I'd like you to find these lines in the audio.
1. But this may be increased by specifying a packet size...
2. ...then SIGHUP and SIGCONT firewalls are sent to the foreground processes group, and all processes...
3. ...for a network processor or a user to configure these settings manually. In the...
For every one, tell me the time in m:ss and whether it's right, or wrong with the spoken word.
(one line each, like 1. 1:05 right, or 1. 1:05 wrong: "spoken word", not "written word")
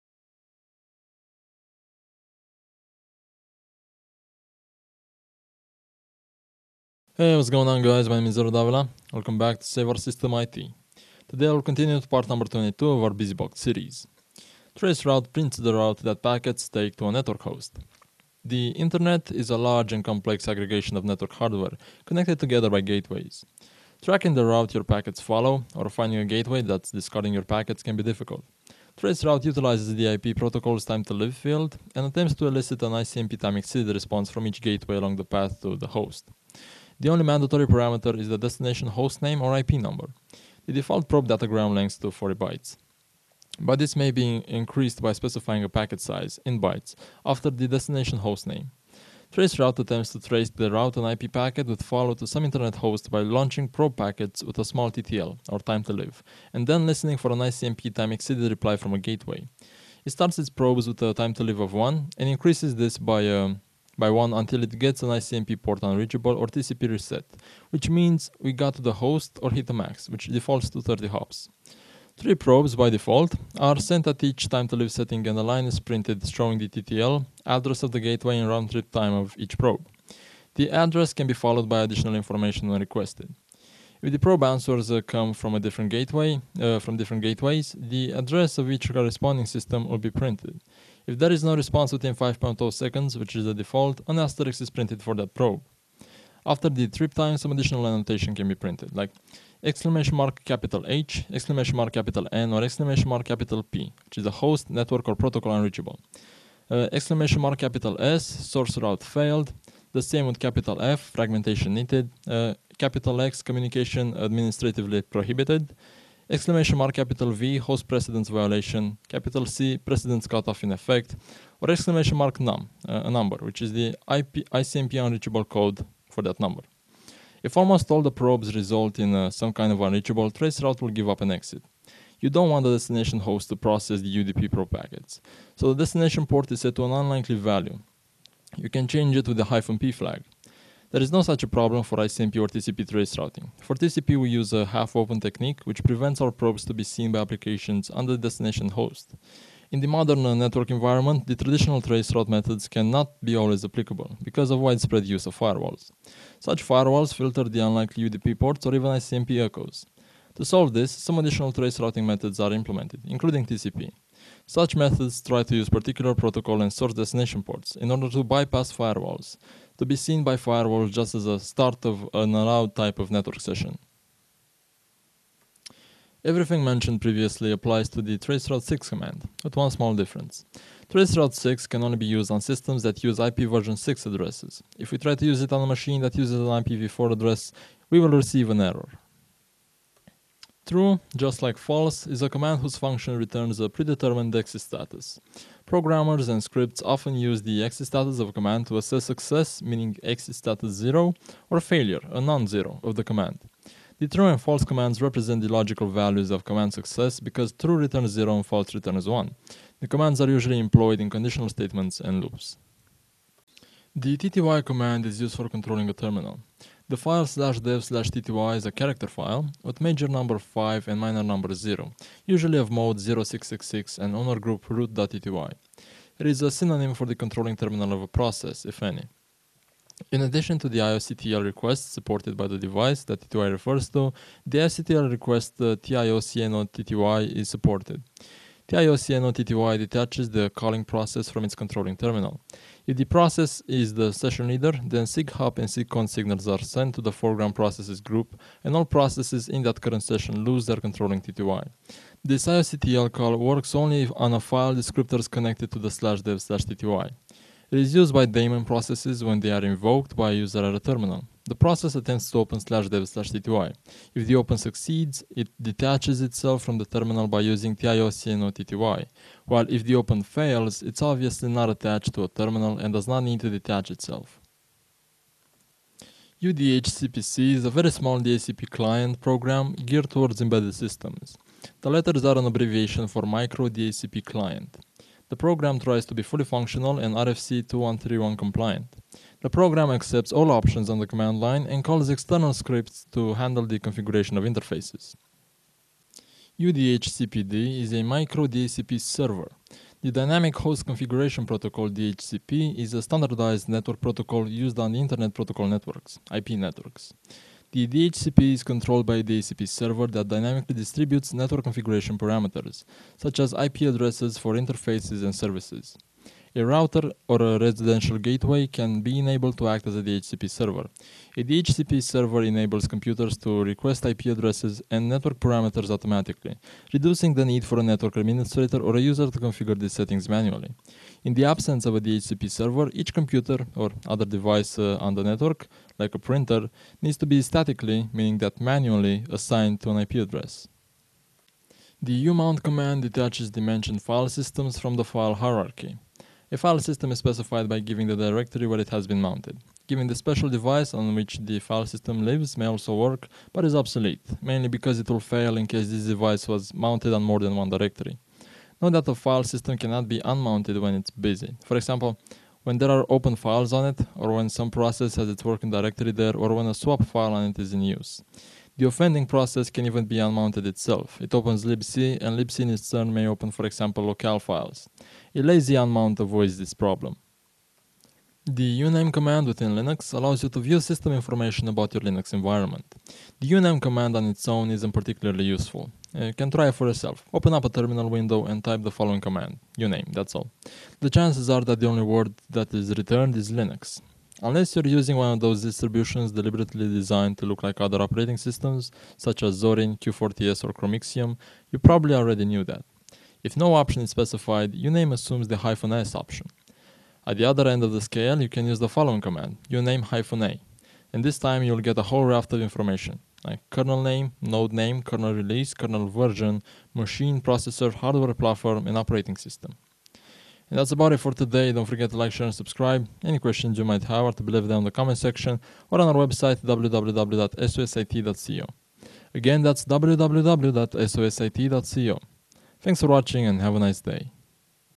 1. 0:43 right
2. 4:04 wrong: "signals", not "firewalls"
3. 5:27 wrong: "administrator", not "processor".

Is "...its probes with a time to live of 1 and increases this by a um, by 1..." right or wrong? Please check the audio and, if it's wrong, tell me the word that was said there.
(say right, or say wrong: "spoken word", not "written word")
right.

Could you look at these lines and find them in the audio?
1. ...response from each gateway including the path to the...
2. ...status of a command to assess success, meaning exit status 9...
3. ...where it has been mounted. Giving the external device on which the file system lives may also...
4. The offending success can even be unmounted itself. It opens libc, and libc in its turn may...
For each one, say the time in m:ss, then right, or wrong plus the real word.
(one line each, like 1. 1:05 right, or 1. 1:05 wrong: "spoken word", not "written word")
1. 0:33 wrong: "along", not "including"
2. 3:17 wrong: "0", not "9"
3. 5:48 wrong: "special", not "external"
4. 6:08 wrong: "process", not "success".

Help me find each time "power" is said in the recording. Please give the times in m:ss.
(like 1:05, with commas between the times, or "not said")
not said.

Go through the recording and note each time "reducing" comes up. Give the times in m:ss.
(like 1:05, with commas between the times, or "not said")
5:26.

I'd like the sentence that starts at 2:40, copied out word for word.
To solve this, some additional trace routing methods are implemented, including TCP.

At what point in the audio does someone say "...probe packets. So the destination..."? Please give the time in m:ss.
2:14.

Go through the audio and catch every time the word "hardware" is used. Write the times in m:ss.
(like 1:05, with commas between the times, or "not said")
0:21, 6:57.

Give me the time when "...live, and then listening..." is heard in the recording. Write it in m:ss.
0:55.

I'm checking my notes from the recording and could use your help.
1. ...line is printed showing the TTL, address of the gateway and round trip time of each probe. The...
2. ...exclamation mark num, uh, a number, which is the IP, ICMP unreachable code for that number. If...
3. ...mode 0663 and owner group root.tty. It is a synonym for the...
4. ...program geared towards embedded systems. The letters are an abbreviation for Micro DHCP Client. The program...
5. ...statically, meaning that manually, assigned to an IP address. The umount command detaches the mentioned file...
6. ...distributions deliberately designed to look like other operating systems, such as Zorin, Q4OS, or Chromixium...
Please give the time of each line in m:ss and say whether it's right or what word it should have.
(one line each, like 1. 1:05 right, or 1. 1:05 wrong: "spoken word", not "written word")
1. 1:15 right
2. 2:01 right
3. 3:42 wrong: "0666", not "0663"
4. 4:39 right
5. 5:37 right
6. 6:35 right.